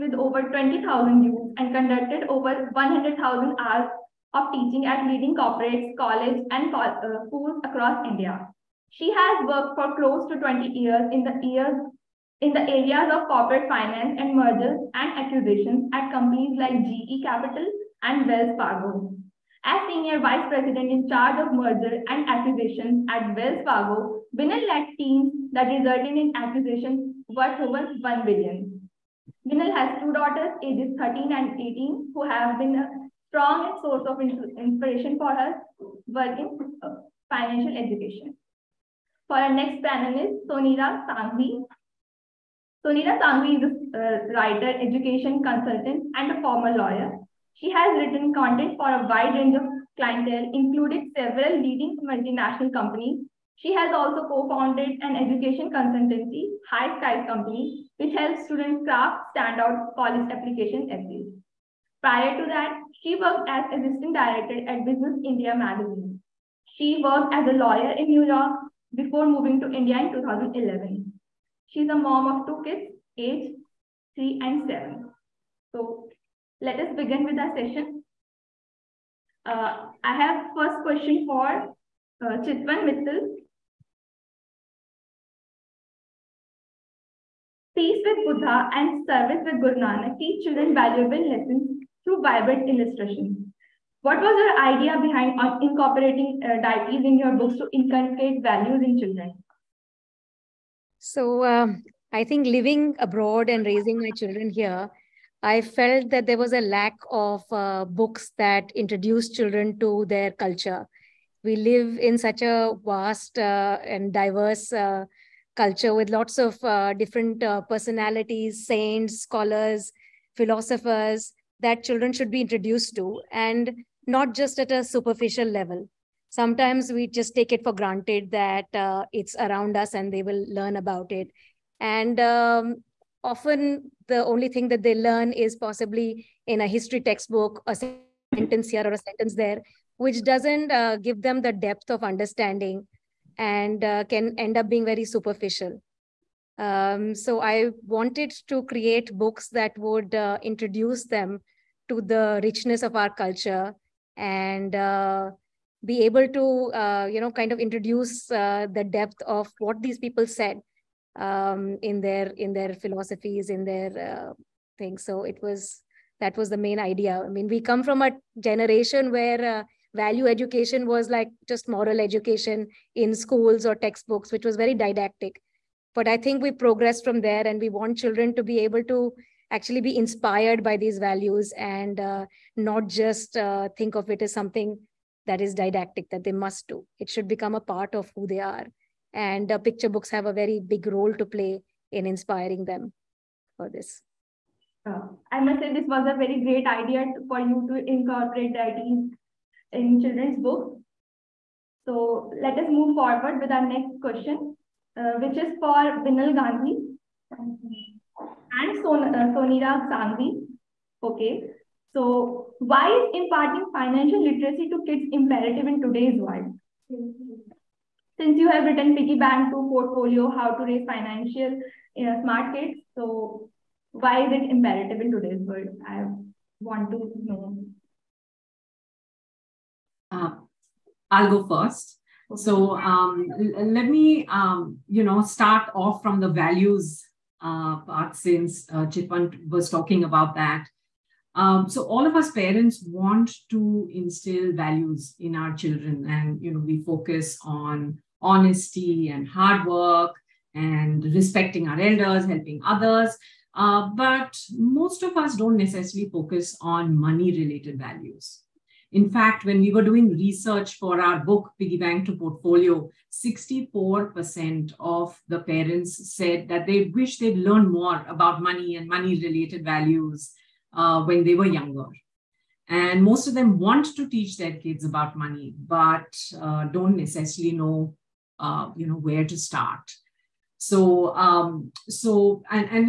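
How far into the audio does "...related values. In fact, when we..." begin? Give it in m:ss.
4:17.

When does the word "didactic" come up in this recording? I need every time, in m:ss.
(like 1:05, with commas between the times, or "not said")
2:54, 3:05.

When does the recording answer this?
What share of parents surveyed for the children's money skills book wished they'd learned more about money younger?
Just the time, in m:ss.
4:23.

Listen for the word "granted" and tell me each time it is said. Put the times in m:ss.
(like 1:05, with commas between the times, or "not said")
2:07.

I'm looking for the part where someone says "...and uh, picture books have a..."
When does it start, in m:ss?
3:09.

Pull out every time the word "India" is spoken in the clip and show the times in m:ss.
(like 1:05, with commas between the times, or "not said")
0:08, 1:05, 1:09.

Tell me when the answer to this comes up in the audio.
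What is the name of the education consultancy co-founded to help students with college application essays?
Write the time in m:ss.
0:56.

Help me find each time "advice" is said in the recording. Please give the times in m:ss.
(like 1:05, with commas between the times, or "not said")
not said.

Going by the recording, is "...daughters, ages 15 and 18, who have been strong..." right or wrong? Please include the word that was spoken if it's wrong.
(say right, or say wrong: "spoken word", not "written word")
wrong: "13", not "15".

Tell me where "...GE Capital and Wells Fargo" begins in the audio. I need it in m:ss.
0:16.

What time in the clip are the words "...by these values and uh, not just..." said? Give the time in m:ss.
3:00.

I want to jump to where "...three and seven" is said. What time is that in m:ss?
1:14.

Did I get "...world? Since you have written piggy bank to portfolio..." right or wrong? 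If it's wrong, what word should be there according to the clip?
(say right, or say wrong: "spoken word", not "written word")
right.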